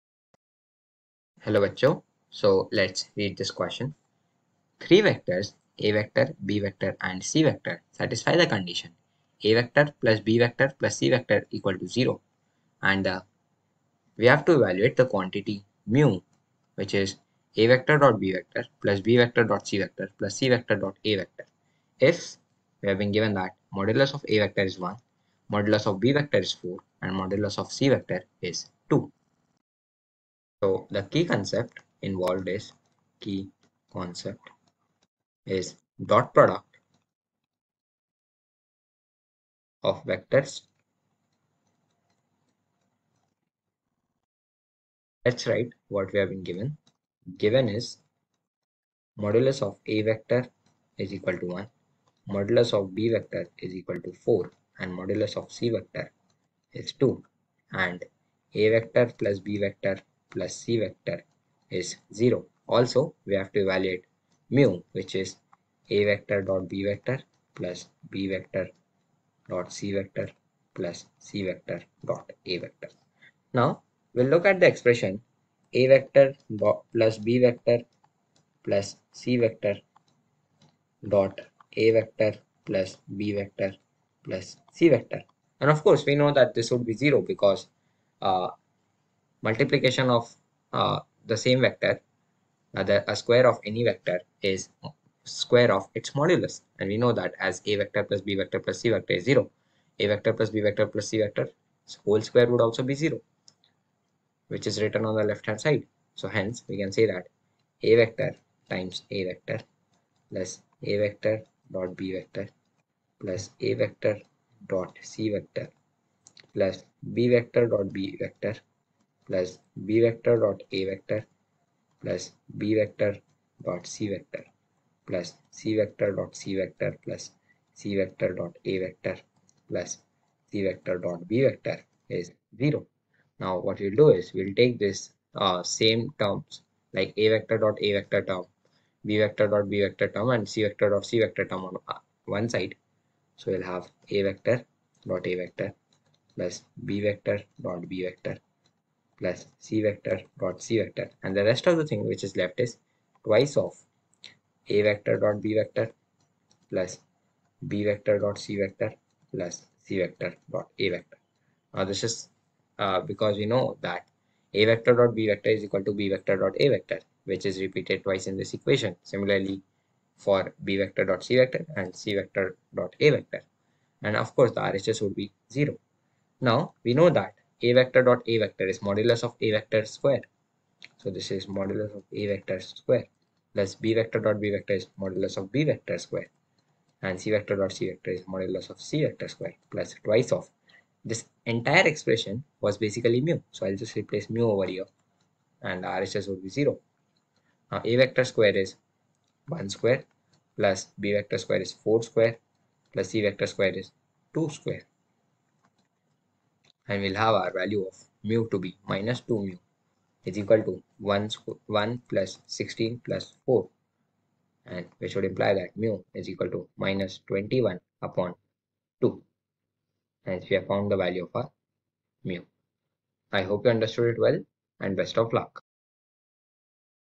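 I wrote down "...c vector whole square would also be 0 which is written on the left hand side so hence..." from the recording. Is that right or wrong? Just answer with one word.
right.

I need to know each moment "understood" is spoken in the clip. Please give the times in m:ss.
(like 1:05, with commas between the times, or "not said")
3:43.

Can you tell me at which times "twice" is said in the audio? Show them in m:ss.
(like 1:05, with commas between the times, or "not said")
2:33, 2:48, 3:10.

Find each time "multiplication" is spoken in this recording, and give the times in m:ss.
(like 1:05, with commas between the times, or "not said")
1:29.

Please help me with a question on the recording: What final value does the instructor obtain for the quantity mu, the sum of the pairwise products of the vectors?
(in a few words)
-21/2.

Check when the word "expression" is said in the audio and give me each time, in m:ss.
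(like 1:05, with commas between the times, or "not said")
1:14, 3:11.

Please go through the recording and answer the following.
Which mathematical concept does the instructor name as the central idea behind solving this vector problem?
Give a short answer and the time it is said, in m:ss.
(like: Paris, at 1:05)
dot product of vectors, at 0:36.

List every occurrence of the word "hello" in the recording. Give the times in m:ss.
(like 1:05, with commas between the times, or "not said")
0:01.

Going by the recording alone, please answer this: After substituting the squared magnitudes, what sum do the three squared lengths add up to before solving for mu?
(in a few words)
21.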